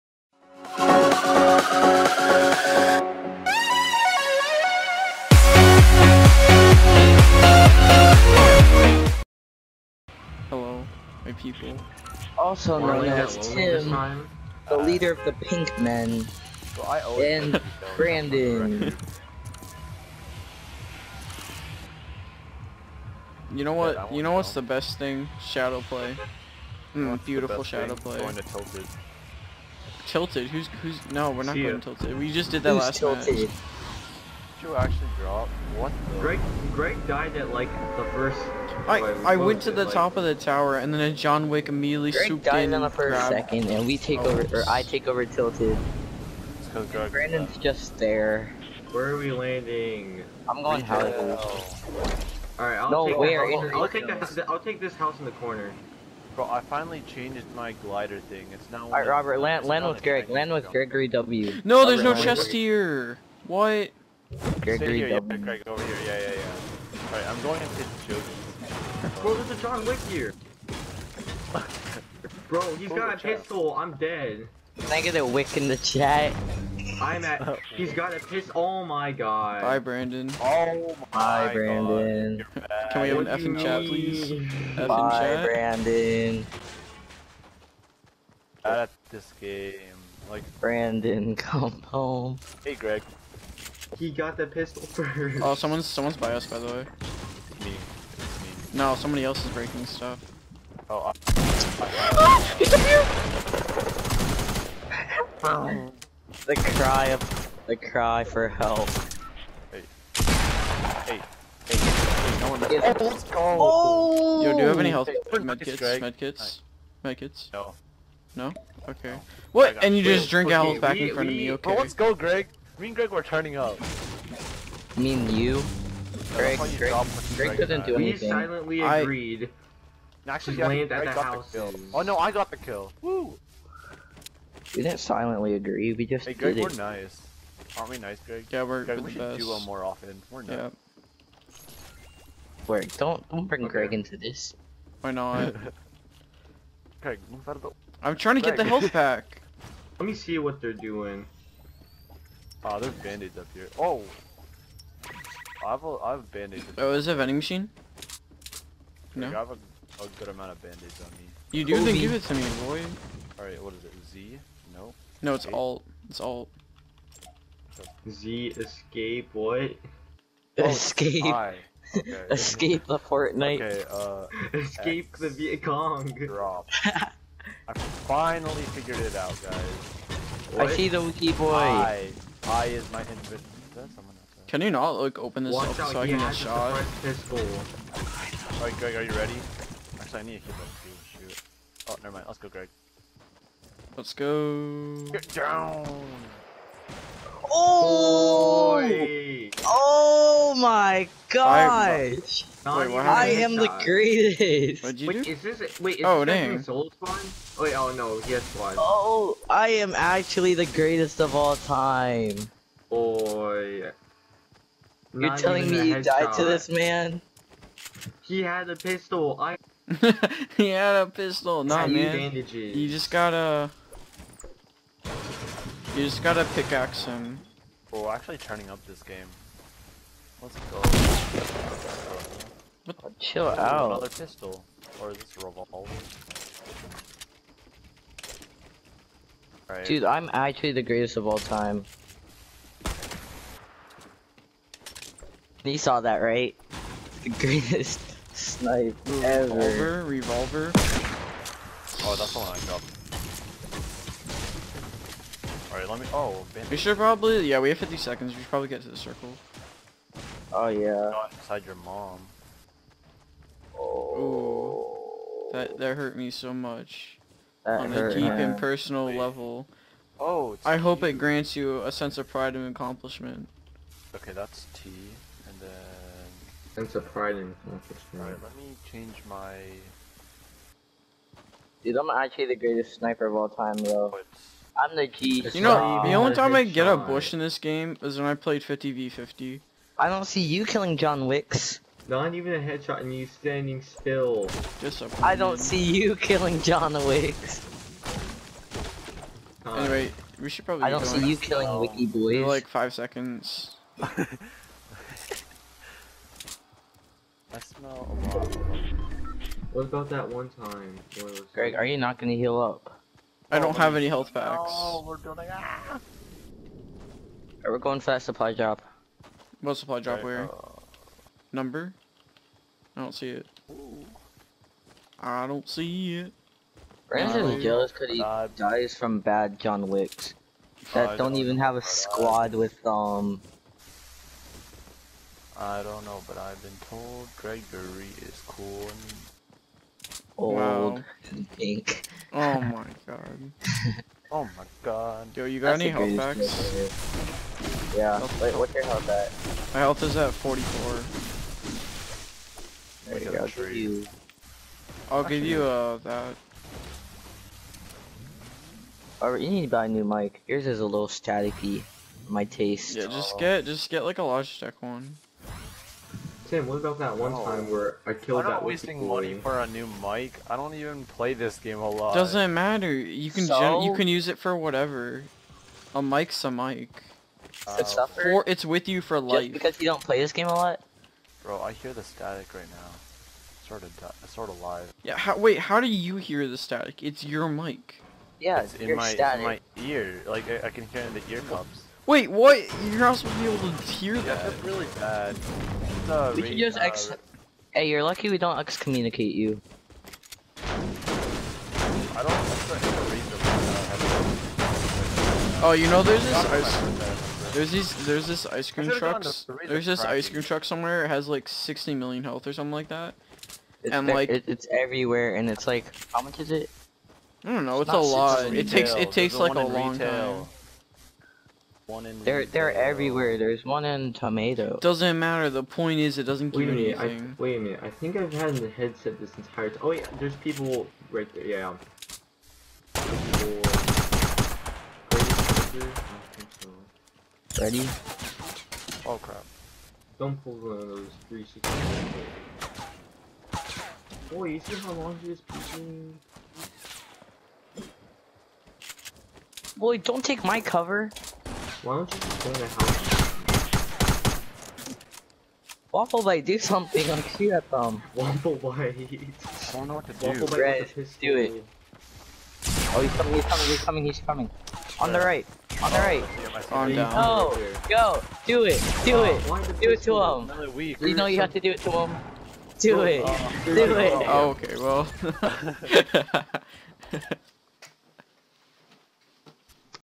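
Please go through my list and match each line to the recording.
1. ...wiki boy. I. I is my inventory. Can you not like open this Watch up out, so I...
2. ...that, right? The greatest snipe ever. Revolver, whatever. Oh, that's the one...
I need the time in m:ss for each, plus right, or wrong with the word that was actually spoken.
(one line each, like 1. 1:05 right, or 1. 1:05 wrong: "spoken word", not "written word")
1. 3:01 right
2. 4:06 wrong: "revolver", not "whatever".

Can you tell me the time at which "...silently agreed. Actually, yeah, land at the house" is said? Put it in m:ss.
2:08.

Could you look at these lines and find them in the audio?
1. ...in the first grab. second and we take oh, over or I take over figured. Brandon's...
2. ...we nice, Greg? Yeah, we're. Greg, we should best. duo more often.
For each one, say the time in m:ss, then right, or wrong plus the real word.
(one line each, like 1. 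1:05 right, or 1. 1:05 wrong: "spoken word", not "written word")
1. 0:42 wrong: "tilted", not "figured"
2. 2:17 right.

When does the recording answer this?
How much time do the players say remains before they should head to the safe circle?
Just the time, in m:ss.
4:17.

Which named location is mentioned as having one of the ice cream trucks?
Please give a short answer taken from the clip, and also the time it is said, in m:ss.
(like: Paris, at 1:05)
Tomato, at 7:03.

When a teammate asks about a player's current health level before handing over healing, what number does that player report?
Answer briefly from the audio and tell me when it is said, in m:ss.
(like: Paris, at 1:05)
44, at 5:49.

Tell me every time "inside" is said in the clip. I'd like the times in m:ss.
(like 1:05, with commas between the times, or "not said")
4:21.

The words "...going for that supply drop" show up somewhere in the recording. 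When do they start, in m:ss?
5:17.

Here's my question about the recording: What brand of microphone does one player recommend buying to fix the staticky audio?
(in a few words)
Logitech.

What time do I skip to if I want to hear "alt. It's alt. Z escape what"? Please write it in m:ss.
2:45.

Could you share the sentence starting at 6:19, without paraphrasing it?
Just because you don't play this game a lot.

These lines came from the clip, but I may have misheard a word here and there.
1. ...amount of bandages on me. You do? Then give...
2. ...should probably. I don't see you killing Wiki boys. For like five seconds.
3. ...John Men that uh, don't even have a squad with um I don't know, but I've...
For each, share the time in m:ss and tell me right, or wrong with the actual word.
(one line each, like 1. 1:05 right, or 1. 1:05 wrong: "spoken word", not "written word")
1. 2:40 right
2. 5:00 right
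3. 5:29 wrong: "Wicks", not "Men".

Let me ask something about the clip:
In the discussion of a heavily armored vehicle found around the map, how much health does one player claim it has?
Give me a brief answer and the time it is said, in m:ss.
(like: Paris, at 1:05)
60 million, at 6:51.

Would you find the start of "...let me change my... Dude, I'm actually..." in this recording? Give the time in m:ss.
4:38.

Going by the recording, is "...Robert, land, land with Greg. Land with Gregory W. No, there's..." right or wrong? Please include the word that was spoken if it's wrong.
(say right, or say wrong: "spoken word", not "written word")
right.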